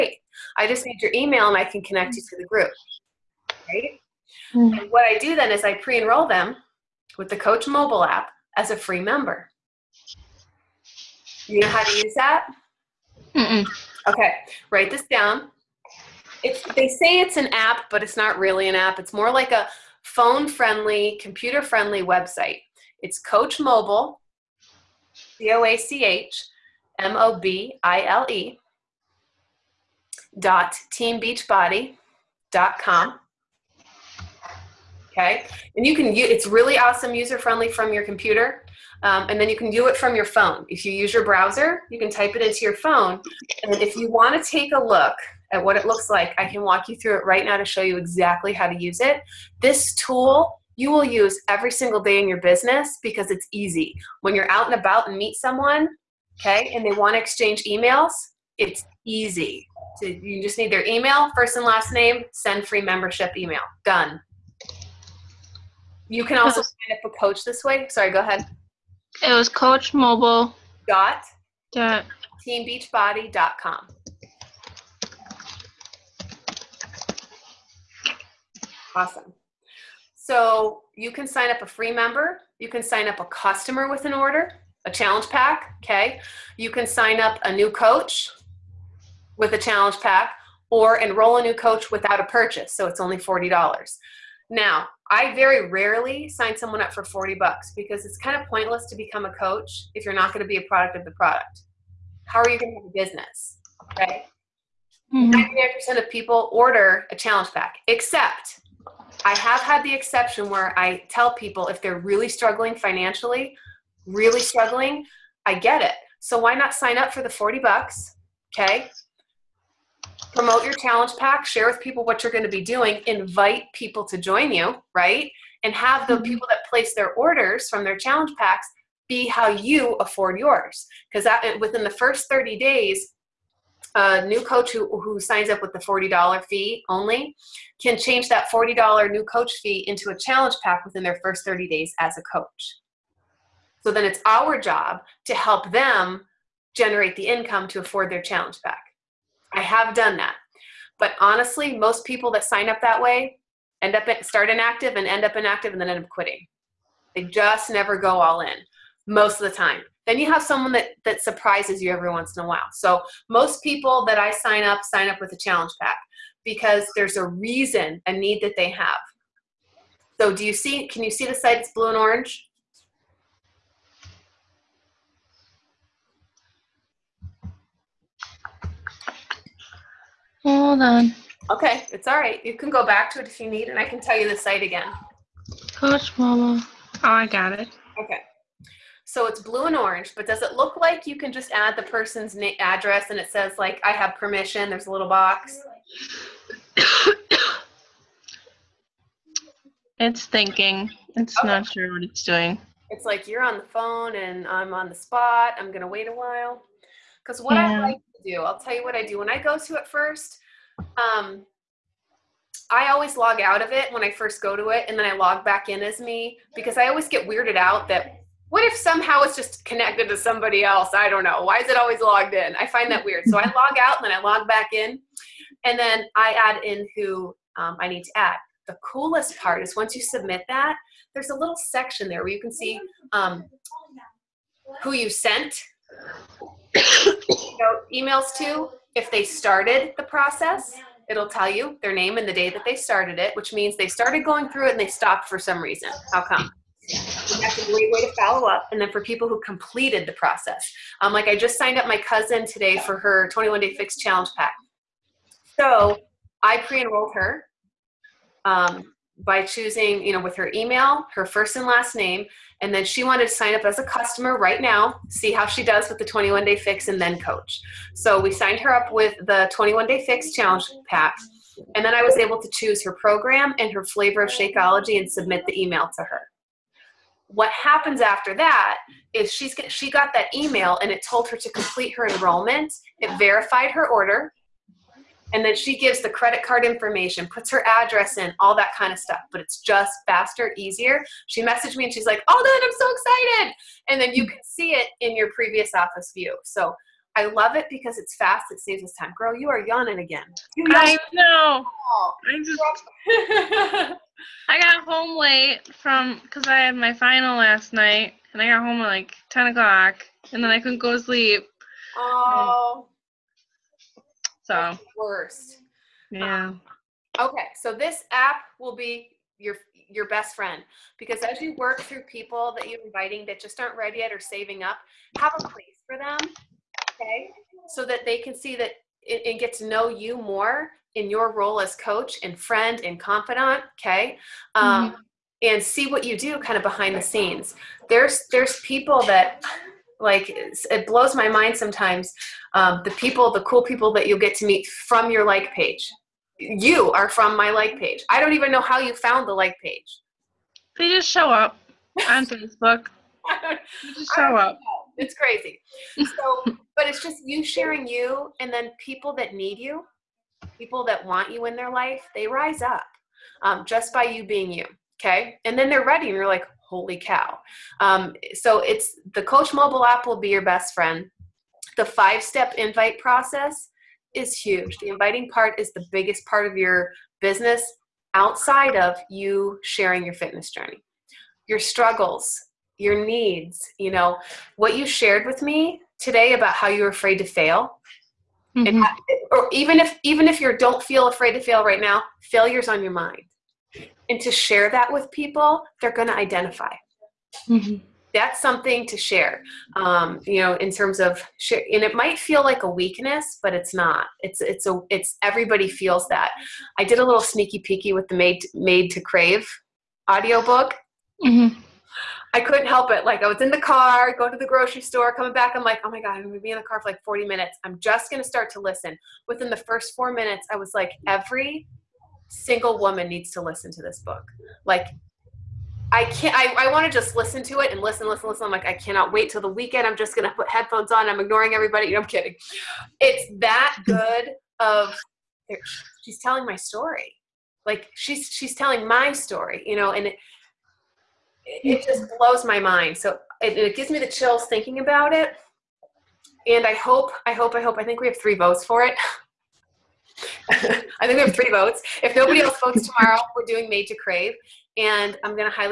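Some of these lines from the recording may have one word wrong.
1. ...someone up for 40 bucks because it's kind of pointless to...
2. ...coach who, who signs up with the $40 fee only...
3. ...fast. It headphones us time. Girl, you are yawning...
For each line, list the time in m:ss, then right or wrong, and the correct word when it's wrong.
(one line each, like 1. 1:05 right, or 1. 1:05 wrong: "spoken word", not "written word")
1. 1:36 right
2. 2:14 right
3. 4:58 wrong: "saves", not "headphones".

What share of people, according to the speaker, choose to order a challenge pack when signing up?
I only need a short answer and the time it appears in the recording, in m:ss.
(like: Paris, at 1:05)
99%, at 1:45.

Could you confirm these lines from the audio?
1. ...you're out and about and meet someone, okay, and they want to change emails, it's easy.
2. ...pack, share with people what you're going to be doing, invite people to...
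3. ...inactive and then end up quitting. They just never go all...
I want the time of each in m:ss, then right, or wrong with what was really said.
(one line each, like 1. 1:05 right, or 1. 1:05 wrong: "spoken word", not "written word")
1. 0:54 wrong: "exchange", not "change"
2. 2:01 right
3. 2:35 right.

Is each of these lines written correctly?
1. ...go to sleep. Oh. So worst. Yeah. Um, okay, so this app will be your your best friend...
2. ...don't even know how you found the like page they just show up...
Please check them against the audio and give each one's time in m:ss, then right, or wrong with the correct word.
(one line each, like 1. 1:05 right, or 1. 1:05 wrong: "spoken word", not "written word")
1. 5:10 right
2. 5:48 right.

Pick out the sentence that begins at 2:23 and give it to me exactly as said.
So then it's our job to help them generate the income to afford their challenge pack.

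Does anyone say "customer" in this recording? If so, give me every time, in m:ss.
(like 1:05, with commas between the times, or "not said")
1:23, 4:23.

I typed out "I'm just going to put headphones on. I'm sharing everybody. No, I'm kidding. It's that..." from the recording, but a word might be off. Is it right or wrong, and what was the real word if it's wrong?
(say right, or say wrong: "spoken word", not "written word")
wrong: "ignoring", not "sharing".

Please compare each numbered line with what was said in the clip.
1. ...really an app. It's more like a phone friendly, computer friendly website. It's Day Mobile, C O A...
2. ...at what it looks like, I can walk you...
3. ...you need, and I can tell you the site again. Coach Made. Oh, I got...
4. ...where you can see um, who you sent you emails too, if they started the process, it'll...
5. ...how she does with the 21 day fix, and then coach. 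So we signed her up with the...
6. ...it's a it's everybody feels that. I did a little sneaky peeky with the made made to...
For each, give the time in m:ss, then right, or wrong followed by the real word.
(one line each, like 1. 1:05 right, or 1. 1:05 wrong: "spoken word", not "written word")
1. 0:18 wrong: "Coach", not "Day"
2. 0:45 right
3. 3:03 wrong: "Mama", not "Made"
4. 3:52 right
5. 4:25 right
6. 6:44 right.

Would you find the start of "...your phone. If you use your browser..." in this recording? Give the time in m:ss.
0:40.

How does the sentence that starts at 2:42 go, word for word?
So most people that I sign up sign up with a challenge pack because there's a reason, a need that they have.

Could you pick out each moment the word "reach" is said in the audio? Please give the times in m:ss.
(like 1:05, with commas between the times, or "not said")
not said.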